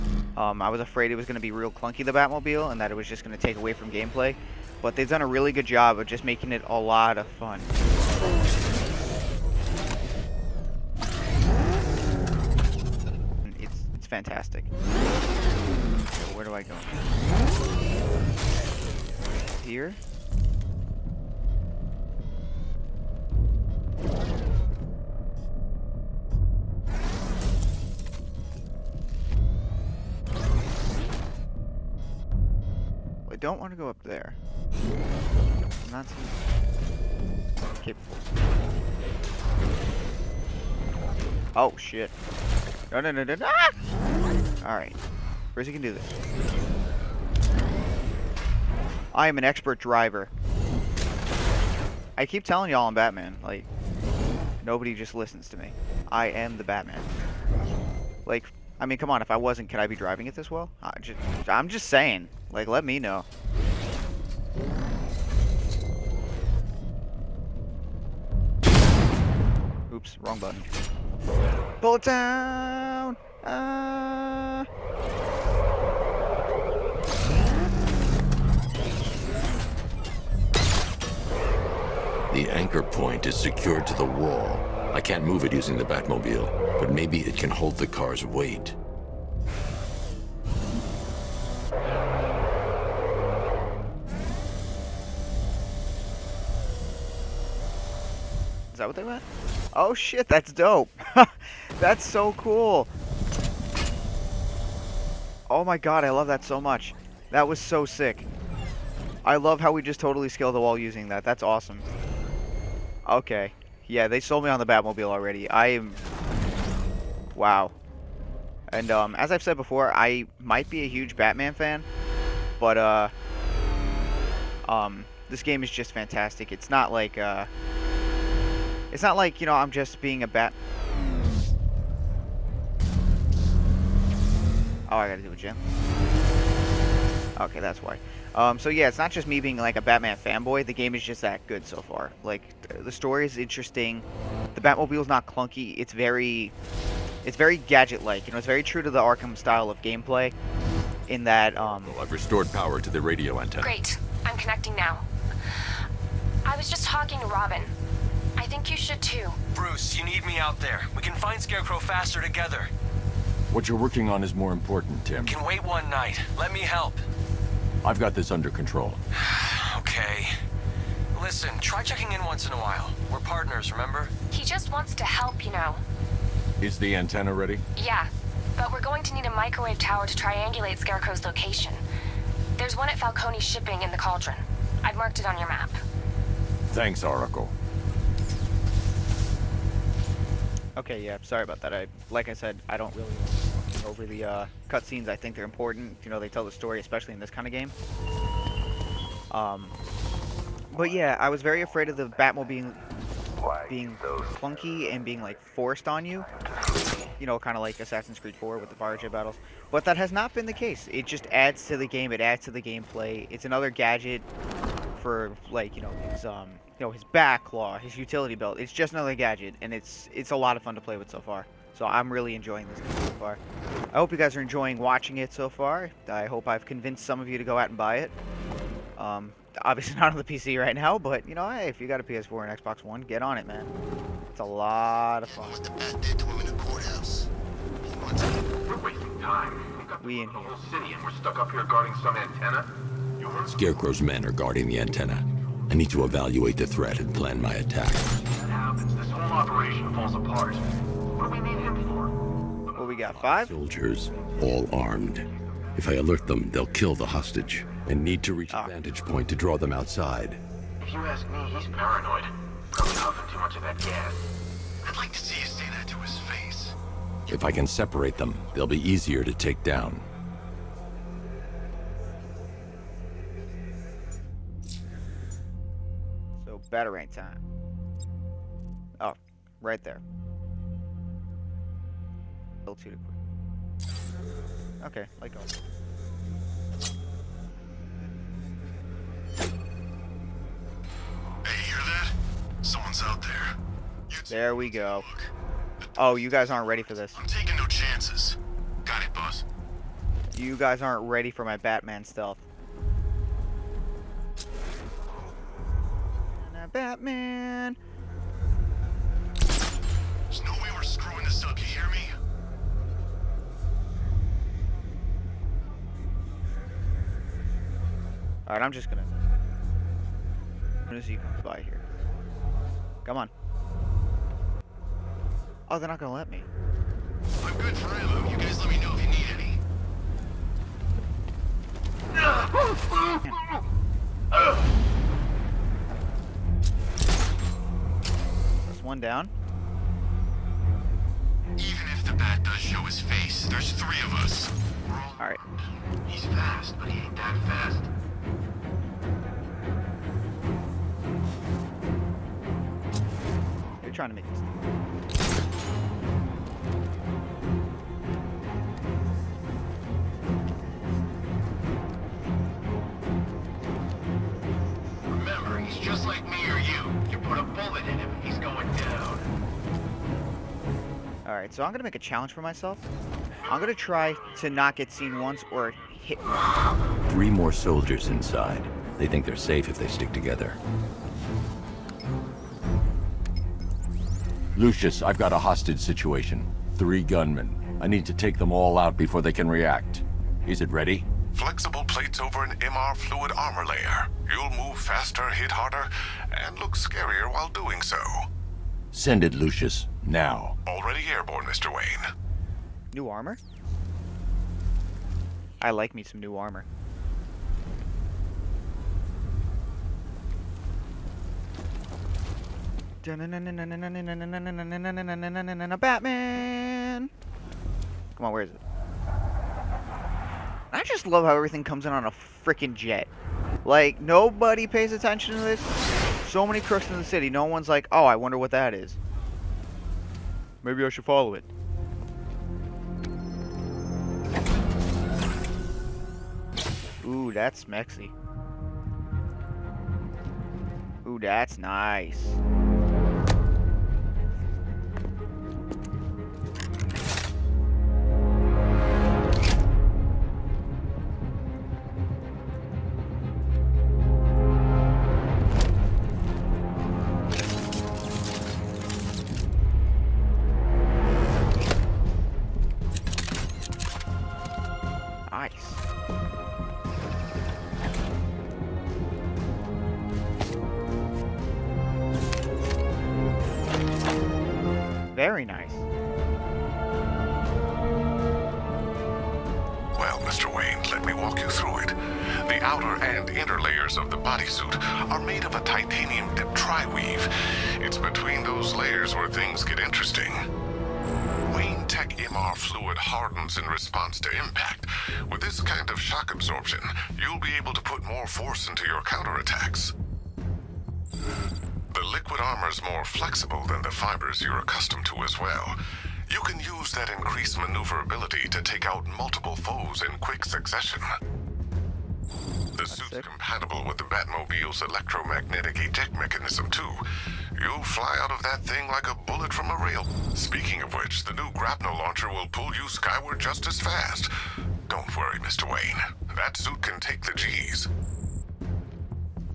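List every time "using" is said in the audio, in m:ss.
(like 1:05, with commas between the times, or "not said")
1:25, 1:50.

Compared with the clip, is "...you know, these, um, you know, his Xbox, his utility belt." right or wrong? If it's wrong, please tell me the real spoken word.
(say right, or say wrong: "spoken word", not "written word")
wrong: "Batclaw", not "Xbox".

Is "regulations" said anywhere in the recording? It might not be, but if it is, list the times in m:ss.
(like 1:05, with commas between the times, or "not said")
not said.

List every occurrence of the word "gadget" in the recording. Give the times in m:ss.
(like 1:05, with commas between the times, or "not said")
2:27, 3:33, 3:39.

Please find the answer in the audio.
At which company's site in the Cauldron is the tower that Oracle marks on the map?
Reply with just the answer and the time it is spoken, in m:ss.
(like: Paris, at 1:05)
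Falcone Shipping, at 3:02.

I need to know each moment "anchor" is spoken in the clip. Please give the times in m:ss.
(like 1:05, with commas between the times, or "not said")
1:22.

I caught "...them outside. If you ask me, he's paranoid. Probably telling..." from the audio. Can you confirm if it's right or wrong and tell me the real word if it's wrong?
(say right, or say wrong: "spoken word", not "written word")
wrong: "huffing", not "telling".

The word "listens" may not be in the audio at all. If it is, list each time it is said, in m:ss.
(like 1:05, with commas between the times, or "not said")
0:55, 2:51.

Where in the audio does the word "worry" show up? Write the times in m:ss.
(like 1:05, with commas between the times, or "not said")
8:45.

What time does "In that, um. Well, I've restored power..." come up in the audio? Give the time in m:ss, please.
2:31.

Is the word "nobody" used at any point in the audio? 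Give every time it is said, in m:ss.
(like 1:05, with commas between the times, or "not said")
0:54, 7:04.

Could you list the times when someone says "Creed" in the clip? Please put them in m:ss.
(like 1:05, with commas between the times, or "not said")
3:28.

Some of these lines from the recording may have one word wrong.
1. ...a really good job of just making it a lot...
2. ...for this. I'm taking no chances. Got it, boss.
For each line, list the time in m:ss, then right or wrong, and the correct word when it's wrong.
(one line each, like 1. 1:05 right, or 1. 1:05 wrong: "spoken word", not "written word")
1. 0:05 right
2. 4:56 right.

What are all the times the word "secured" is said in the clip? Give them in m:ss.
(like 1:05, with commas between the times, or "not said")
1:23.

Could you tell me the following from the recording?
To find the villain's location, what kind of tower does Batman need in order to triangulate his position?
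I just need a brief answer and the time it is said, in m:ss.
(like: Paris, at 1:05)
Microwave tower, at 2:59.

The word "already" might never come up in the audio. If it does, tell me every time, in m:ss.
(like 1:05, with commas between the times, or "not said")
1:55, 6:40.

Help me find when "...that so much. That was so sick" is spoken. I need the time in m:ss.
1:46.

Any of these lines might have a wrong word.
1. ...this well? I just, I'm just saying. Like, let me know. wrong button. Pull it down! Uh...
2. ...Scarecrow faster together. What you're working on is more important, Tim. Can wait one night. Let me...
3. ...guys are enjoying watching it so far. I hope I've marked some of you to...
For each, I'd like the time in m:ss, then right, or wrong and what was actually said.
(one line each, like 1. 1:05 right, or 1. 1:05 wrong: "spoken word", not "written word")
1. 1:00 right
2. 2:41 right
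3. 3:44 wrong: "convinced", not "marked".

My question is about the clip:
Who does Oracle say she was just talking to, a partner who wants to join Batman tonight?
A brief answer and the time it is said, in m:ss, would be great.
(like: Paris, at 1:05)
Robin, at 2:37.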